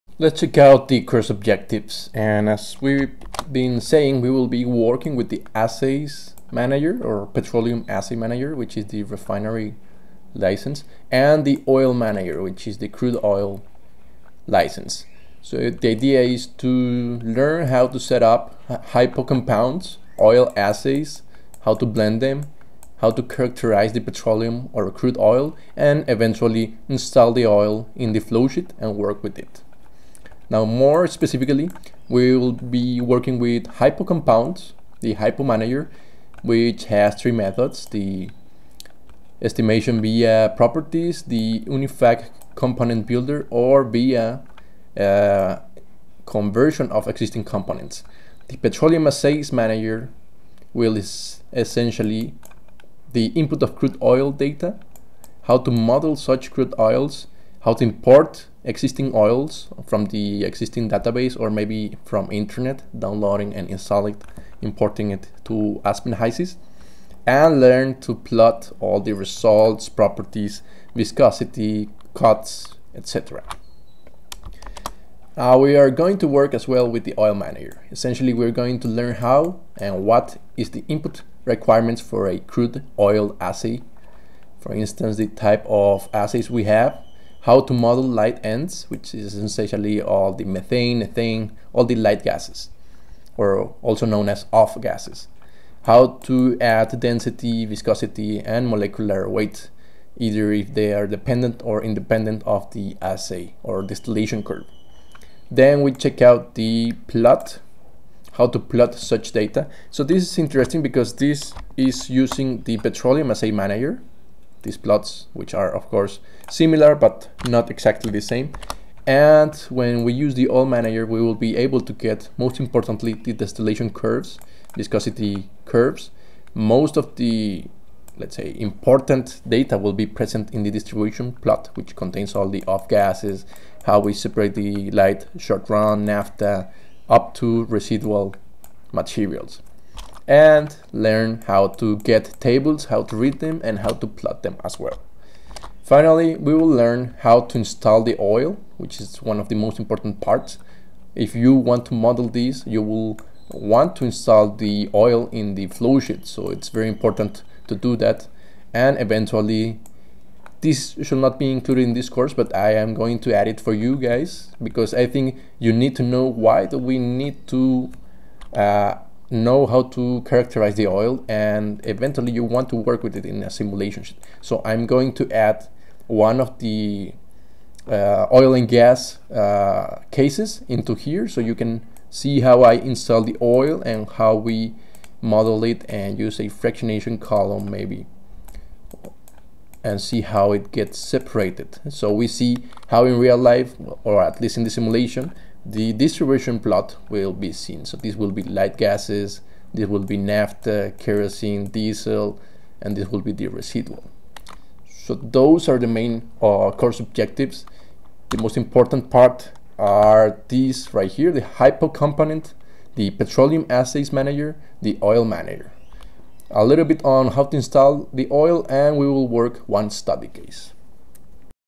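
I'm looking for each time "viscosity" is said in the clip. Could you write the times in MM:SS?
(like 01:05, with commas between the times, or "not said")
01:10, 01:37, 02:04.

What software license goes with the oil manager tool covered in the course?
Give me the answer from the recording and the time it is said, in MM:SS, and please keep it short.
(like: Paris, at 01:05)
crude oil license, at 00:12.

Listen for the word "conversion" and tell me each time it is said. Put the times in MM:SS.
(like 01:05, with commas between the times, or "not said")
00:46.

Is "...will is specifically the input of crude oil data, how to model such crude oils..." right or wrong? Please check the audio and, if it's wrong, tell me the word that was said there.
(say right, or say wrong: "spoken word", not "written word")
wrong: "essentially", not "specifically".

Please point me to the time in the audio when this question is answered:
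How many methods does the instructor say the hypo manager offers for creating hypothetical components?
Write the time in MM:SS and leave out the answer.
00:37.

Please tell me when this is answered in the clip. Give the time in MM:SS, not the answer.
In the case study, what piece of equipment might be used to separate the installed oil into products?
03:06.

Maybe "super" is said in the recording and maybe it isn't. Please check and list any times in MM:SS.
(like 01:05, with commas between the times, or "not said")
not said.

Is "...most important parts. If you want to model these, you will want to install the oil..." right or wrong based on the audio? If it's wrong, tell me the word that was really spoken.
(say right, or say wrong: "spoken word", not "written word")
right.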